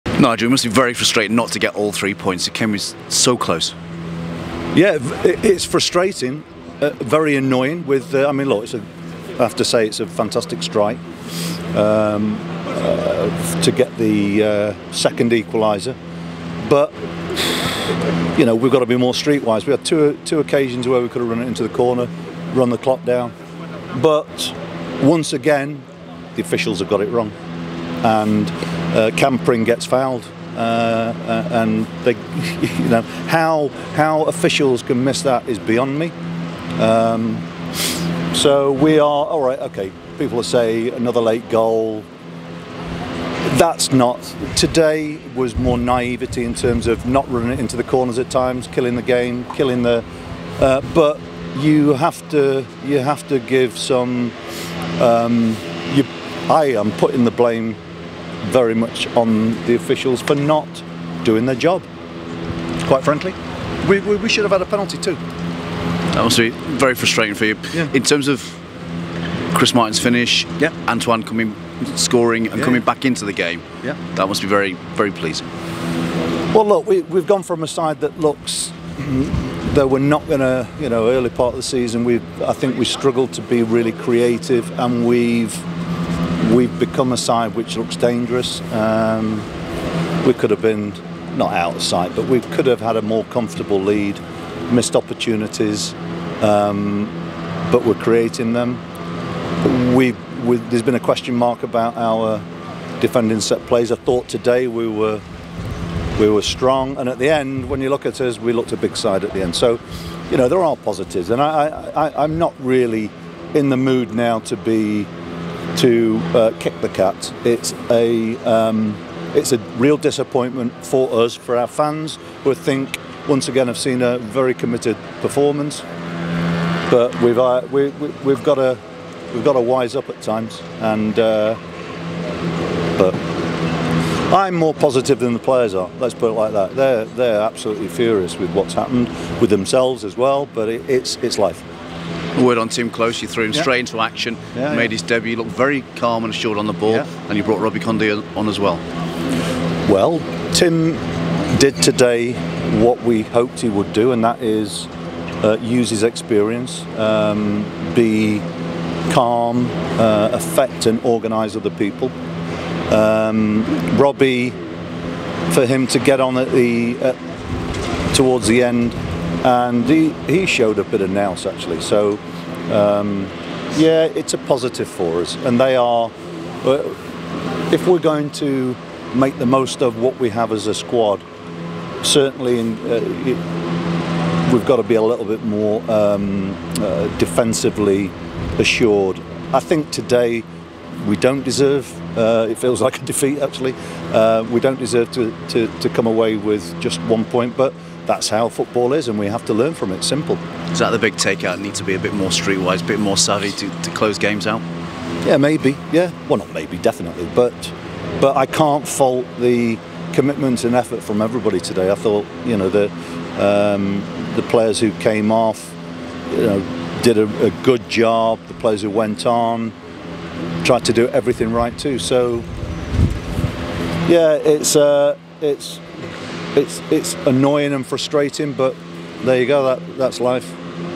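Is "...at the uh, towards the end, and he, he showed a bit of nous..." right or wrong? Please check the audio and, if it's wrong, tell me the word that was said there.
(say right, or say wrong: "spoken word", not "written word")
right.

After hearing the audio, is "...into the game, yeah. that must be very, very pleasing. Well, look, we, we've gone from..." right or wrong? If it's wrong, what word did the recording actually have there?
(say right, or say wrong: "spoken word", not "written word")
right.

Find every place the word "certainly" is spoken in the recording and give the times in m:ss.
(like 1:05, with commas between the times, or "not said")
3:02.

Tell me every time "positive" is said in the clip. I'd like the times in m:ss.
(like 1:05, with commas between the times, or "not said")
1:50, 2:14, 2:54.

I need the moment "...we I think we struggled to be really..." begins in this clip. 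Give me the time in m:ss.
1:22.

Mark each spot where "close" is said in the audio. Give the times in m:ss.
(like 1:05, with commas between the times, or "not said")
0:03, 3:23.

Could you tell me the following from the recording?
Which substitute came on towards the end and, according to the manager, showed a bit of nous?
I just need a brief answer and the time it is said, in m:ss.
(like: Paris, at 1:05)
Robbie Cundy, at 2:27.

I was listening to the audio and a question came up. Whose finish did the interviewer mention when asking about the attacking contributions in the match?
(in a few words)
Chris Martin.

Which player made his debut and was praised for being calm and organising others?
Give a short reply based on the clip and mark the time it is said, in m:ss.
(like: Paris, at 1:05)
Timm Klose, at 2:22.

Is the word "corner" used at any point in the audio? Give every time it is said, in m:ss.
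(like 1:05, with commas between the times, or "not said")
0:21, 0:47.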